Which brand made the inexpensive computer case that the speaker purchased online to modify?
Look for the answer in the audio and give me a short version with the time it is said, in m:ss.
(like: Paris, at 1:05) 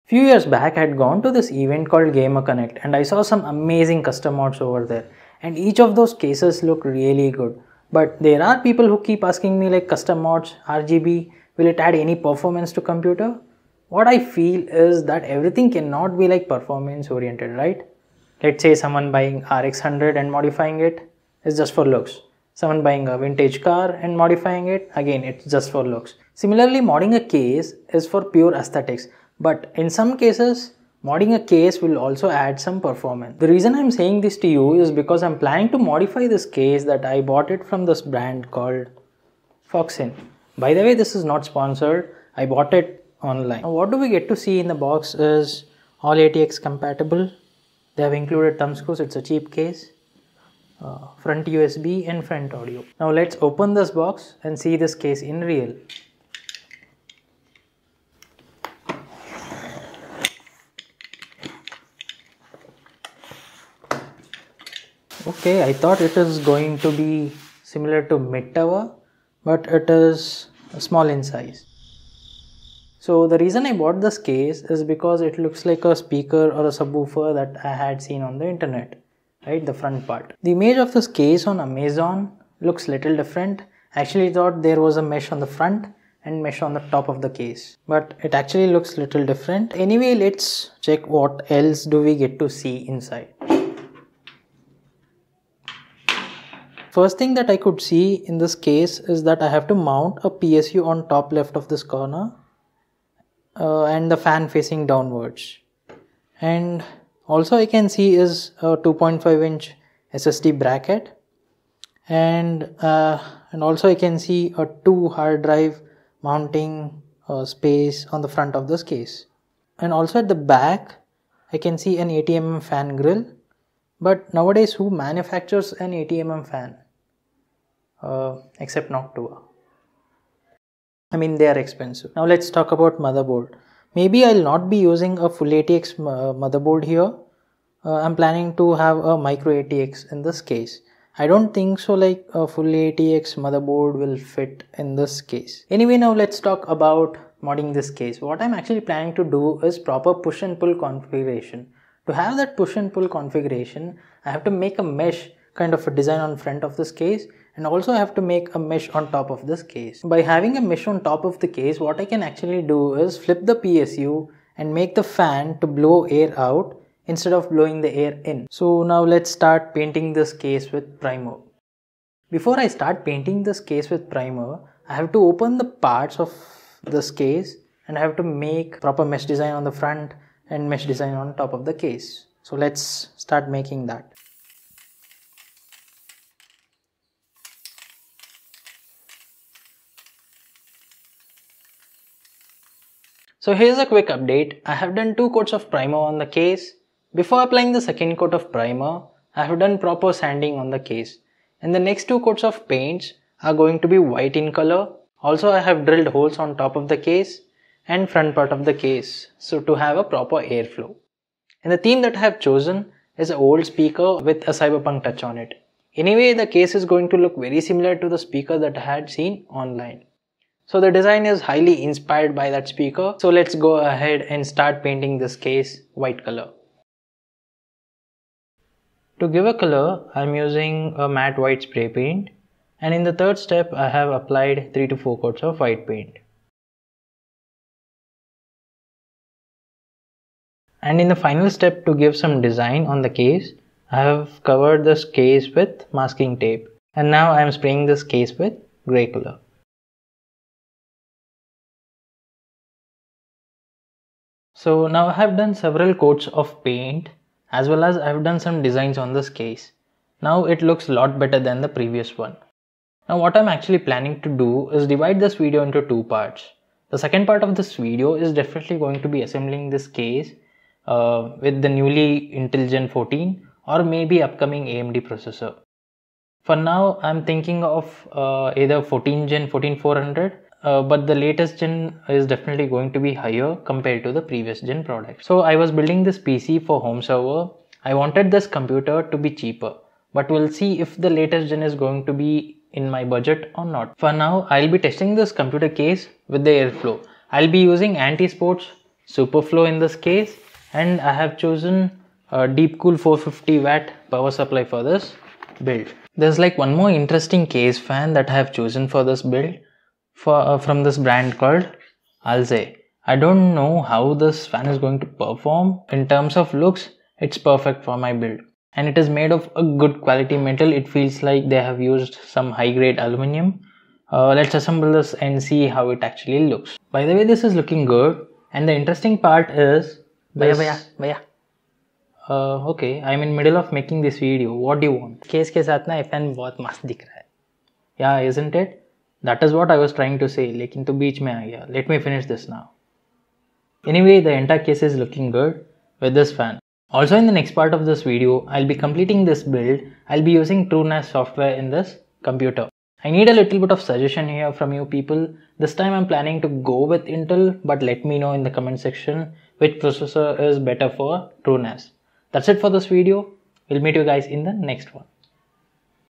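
Foxin, at 0:39.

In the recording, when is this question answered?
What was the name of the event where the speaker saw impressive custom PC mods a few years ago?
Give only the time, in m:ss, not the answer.
0:02.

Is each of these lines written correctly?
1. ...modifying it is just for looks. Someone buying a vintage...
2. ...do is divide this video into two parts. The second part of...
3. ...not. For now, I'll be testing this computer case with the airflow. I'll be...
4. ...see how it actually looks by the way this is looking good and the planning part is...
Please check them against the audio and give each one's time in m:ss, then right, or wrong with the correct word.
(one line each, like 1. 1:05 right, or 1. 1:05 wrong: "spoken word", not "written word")
1. 0:20 right
2. 4:24 right
3. 4:53 right
4. 5:25 wrong: "interesting", not "planning".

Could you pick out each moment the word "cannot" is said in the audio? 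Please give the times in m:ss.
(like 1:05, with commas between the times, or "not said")
0:15.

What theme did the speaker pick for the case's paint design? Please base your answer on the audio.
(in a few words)
Cyberpunk.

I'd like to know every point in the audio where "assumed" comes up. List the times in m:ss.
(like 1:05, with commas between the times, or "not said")
not said.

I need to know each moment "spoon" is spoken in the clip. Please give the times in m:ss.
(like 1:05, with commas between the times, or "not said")
not said.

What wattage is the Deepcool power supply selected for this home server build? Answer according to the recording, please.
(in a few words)
450 watt.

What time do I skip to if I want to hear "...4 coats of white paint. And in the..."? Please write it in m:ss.
3:54.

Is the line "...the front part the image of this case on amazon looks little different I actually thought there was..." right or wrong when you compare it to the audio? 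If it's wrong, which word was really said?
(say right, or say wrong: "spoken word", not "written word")
right.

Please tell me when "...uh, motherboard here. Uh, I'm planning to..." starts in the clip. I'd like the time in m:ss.
2:15.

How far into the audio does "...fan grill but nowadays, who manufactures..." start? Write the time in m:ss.
2:02.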